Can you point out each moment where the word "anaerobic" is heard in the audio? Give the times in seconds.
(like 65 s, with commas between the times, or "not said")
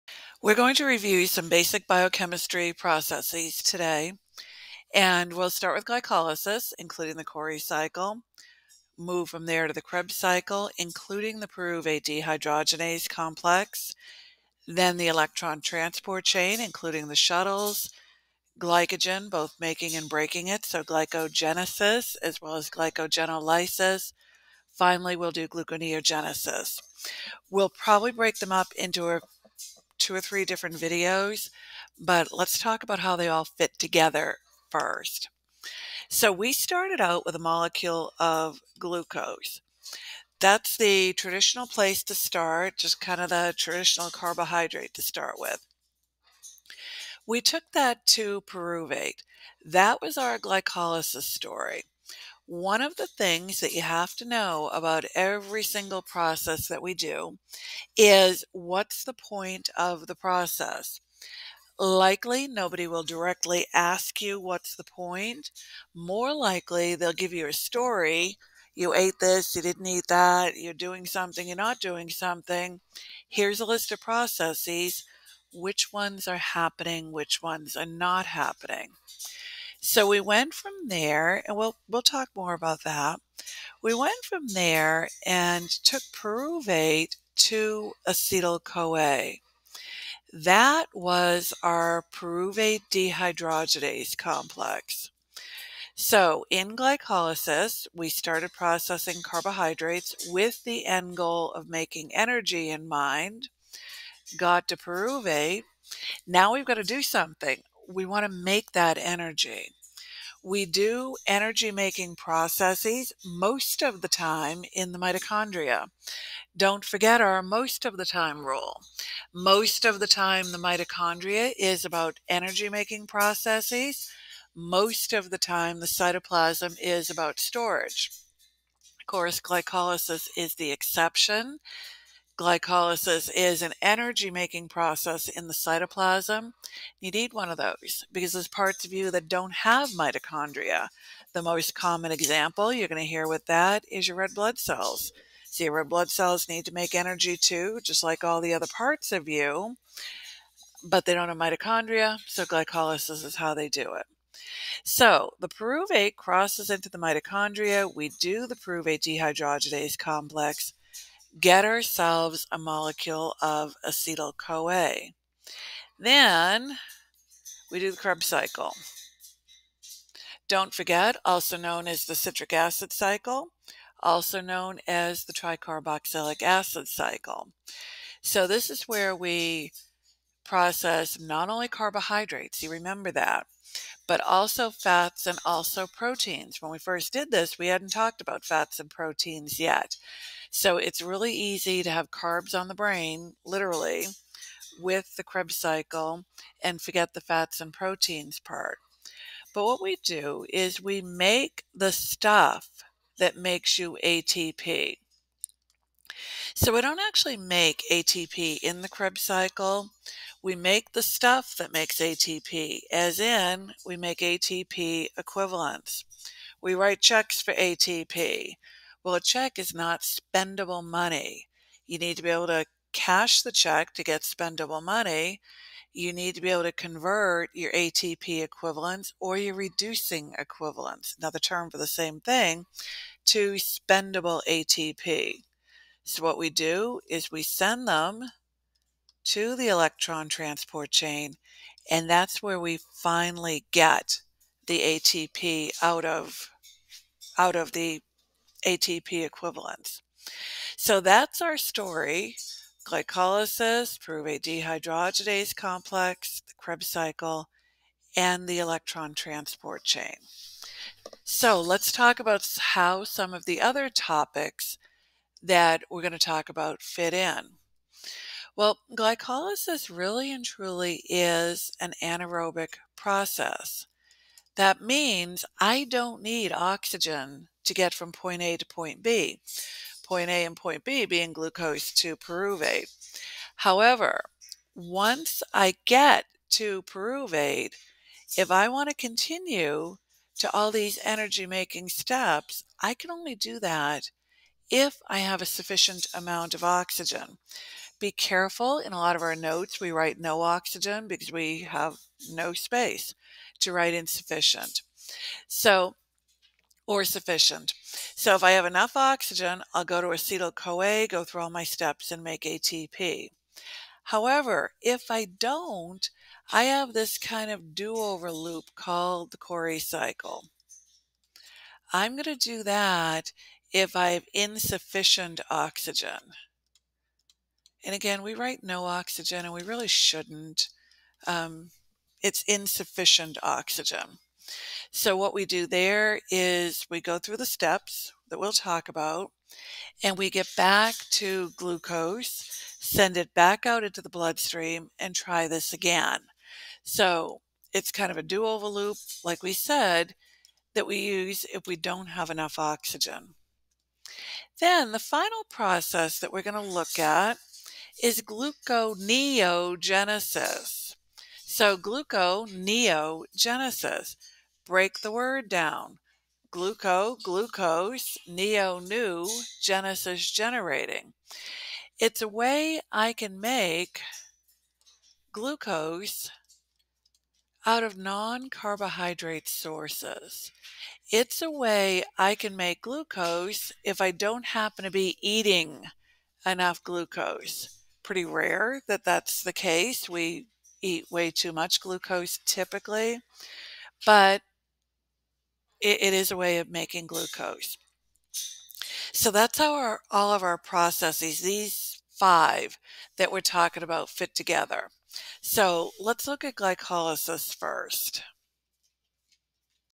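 272 s.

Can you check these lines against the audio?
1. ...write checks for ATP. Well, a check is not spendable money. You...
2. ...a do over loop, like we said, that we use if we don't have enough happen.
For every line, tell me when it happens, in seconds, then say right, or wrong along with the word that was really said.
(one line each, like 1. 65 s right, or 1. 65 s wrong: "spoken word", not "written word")
1. 216 s right
2. 348 s wrong: "oxygen", not "happen".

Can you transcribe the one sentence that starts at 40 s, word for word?
That's the traditional place to start, just kind of the traditional carbohydrate to start with.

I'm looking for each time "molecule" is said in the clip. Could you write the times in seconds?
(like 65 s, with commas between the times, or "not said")
37 s, 162 s.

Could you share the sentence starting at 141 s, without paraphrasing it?
The most common example you're going to hear with that is your red blood cells.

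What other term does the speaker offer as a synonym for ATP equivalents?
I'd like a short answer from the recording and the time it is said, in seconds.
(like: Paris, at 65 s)
reducing equivalents, at 229 s.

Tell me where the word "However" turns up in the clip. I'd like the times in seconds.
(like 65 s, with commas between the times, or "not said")
283 s, 314 s.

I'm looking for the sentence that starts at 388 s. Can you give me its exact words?
Pretty rare that that's the case.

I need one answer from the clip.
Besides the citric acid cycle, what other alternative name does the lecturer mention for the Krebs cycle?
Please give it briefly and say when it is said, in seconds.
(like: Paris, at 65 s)
tricarboxylic acid cycle, at 175 s.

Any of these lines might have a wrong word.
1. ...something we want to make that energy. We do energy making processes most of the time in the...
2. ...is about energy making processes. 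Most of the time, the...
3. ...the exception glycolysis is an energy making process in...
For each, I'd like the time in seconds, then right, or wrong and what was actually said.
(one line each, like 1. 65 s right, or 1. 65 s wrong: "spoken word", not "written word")
1. 107 s right
2. 121 s right
3. 130 s right.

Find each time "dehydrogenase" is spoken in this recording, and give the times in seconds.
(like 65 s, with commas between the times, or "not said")
12 s, 92 s, 159 s, 254 s.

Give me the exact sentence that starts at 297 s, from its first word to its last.
Be careful in a lot of our notes, we write no oxygen because we have no space to write insufficient.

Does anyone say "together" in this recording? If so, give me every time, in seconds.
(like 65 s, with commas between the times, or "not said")
33 s, 404 s.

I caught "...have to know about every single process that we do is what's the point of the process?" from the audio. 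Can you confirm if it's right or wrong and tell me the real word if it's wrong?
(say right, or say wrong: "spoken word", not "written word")
right.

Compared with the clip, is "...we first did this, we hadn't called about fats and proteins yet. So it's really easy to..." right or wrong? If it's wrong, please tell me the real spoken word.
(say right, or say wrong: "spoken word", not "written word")
wrong: "talked", not "called".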